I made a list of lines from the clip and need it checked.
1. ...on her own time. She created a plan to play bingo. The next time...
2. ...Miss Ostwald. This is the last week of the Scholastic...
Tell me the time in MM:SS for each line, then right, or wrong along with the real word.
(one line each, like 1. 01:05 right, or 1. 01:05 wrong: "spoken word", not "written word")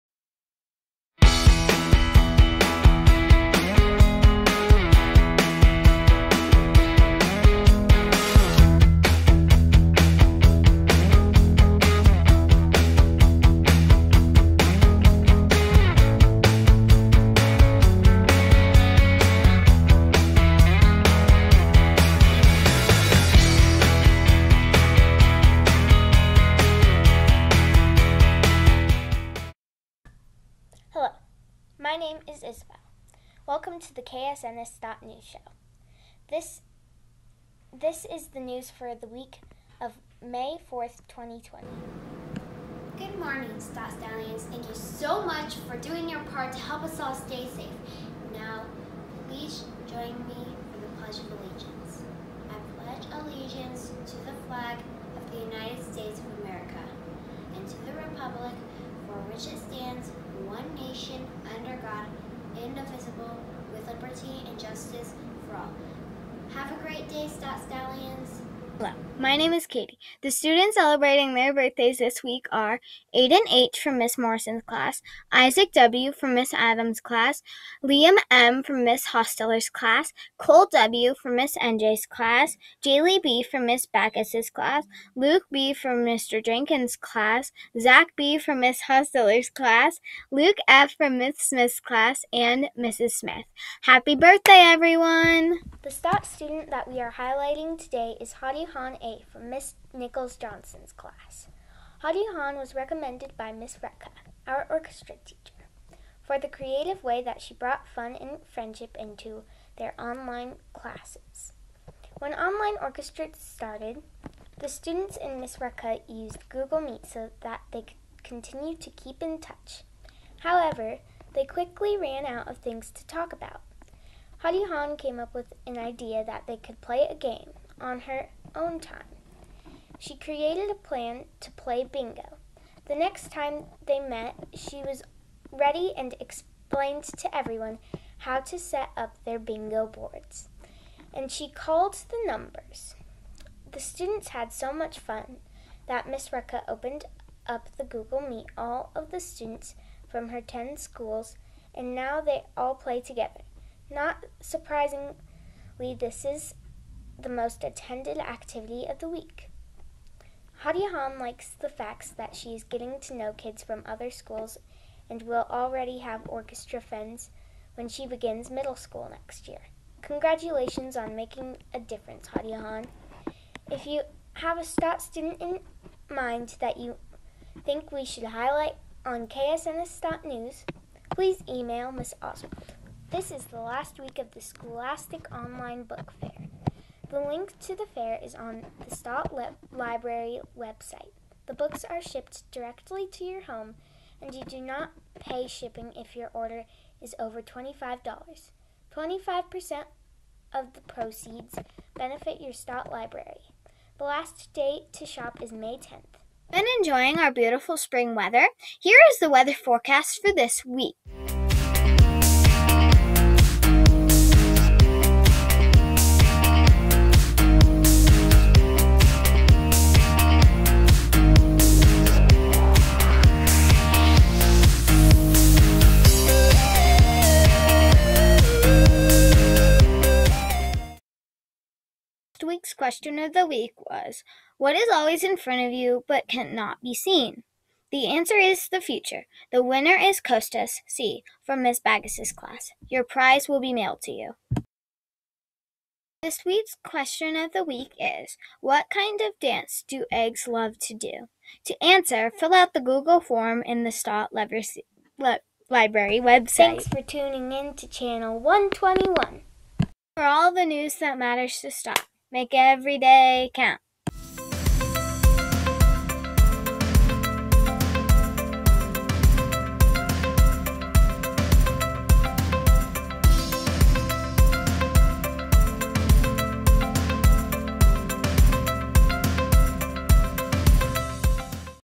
1. 02:07 right
2. 03:01 right.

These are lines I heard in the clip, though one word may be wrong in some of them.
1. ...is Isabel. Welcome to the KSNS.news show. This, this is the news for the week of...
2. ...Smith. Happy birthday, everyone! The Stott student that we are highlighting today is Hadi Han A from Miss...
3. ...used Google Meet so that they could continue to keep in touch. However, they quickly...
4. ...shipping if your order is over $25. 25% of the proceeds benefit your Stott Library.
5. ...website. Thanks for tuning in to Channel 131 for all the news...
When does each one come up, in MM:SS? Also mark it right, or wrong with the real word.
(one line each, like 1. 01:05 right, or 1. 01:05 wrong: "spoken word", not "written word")
1. 00:32 right
2. 01:33 right
3. 01:56 right
4. 03:15 right
5. 04:15 wrong: "121", not "131".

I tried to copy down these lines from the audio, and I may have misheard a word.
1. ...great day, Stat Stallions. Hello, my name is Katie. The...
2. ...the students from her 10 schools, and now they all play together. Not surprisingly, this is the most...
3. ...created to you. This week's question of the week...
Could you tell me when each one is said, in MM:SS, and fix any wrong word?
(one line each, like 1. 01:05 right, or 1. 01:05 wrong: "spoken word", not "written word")
1. 01:06 right
2. 02:29 right
3. 04:03 wrong: "mailed", not "created".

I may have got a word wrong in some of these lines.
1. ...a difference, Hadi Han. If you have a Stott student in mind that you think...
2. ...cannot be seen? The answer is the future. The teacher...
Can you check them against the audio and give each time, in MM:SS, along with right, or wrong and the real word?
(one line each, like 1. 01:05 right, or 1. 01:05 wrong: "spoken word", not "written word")
1. 02:51 right
2. 03:56 wrong: "winner", not "teacher".